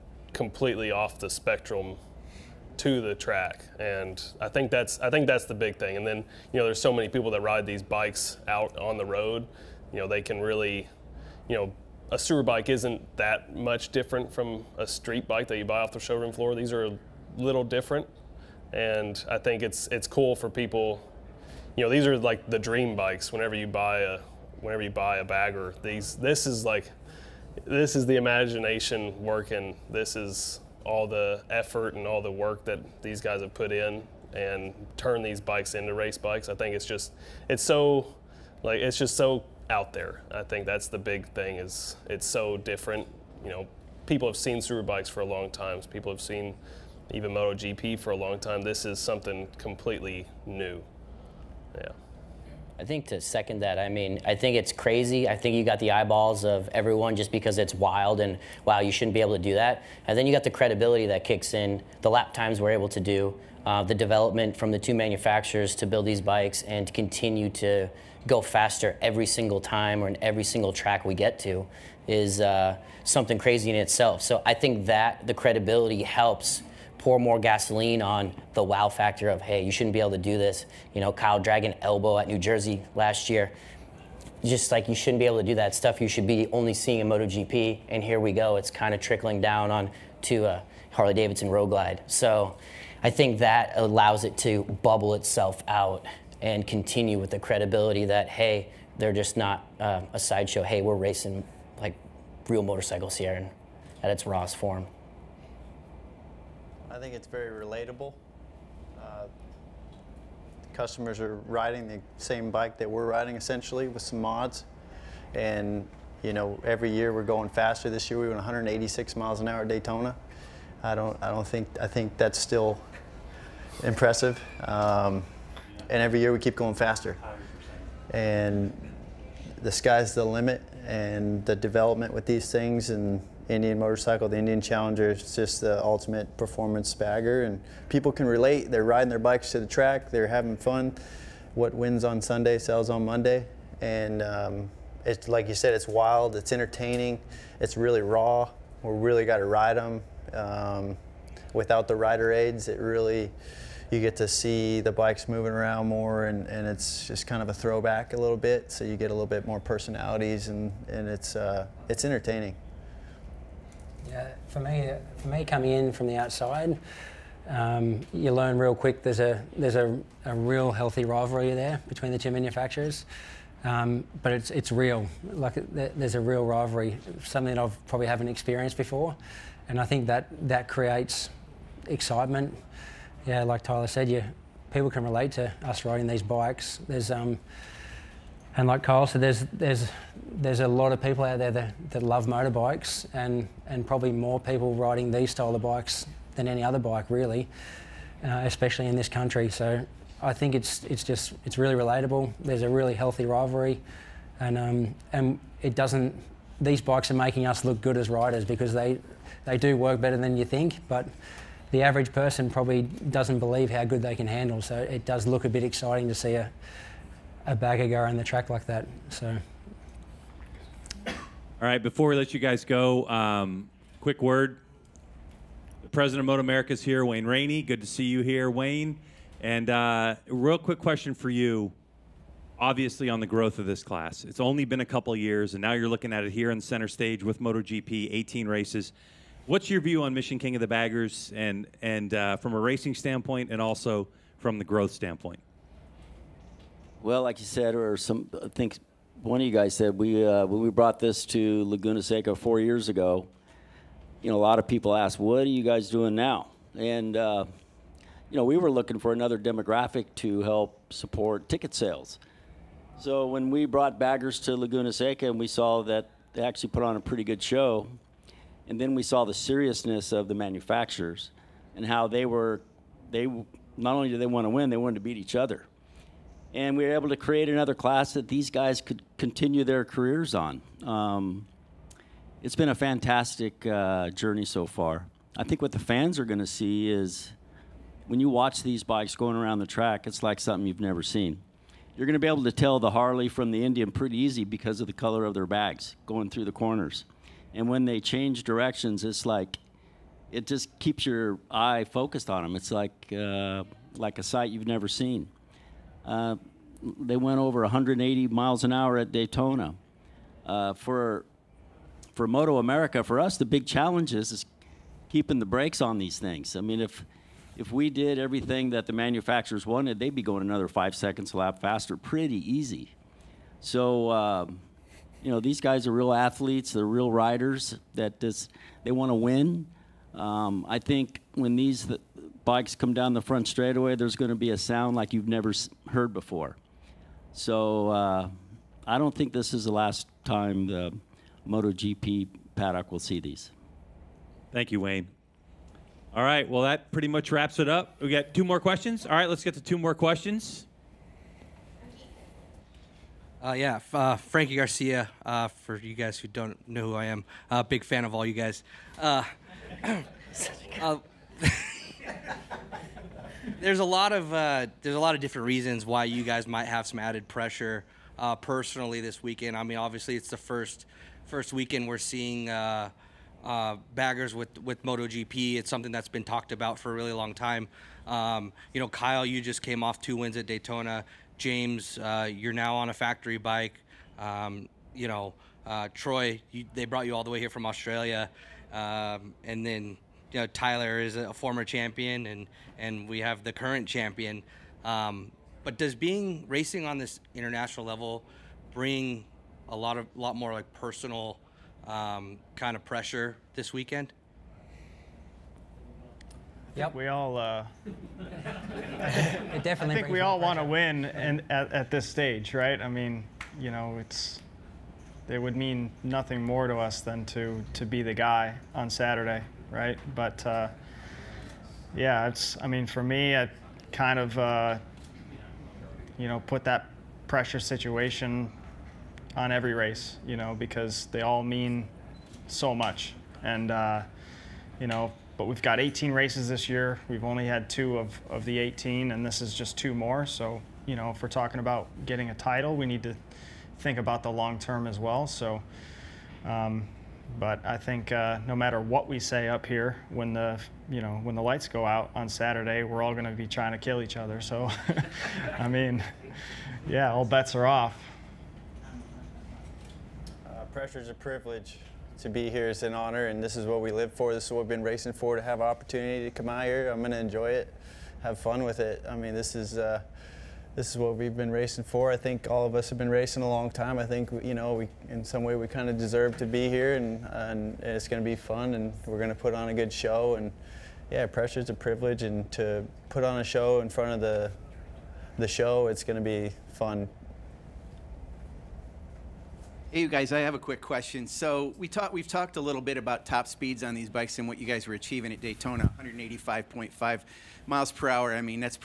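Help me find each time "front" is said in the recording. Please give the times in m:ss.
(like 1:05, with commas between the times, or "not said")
5:33, 8:03.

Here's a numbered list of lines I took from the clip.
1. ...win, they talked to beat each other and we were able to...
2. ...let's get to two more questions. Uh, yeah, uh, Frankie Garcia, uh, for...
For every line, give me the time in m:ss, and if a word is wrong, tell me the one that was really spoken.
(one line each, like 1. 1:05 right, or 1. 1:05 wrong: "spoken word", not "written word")
1. 4:34 wrong: "wanted", not "talked"
2. 5:49 right.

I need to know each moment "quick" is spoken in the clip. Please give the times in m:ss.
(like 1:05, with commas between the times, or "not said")
2:48, 3:44, 3:50, 8:10.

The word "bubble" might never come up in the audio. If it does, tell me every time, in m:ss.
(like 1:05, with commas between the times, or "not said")
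1:34.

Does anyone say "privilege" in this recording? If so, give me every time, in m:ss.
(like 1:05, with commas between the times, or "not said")
7:41, 8:01.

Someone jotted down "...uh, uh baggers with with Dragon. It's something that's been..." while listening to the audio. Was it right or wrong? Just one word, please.
wrong.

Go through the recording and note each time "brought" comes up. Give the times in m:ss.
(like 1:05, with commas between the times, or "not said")
4:10, 4:23, 6:26.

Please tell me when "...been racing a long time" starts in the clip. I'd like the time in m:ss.
7:52.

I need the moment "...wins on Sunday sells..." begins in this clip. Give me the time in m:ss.
2:21.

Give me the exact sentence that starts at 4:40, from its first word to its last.
Um, it's been a fantastic uh, journey so far.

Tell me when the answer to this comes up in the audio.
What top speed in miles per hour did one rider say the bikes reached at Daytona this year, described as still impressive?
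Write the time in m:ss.
1:58.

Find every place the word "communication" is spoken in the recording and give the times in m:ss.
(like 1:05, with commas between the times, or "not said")
not said.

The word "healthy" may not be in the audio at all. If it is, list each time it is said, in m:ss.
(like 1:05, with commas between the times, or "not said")
2:50, 3:22.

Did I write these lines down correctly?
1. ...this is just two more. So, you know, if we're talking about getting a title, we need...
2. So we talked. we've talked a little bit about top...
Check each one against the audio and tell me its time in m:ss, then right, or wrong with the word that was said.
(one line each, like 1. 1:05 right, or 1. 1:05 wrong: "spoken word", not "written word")
1. 7:19 right
2. 8:11 right.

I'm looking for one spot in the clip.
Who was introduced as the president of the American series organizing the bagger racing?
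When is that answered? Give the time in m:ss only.
3:47.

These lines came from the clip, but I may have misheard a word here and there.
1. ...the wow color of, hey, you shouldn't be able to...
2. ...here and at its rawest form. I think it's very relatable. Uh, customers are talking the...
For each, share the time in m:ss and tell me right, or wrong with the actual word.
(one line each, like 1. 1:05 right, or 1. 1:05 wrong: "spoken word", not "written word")
1. 1:18 wrong: "factor", not "color"
2. 1:43 wrong: "riding", not "talking".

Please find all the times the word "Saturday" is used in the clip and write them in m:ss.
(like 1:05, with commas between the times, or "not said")
6:58, 7:32.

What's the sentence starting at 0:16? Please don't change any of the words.
These are a little different, and I think it's it's cool for people.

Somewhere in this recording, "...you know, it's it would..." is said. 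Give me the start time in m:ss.
6:53.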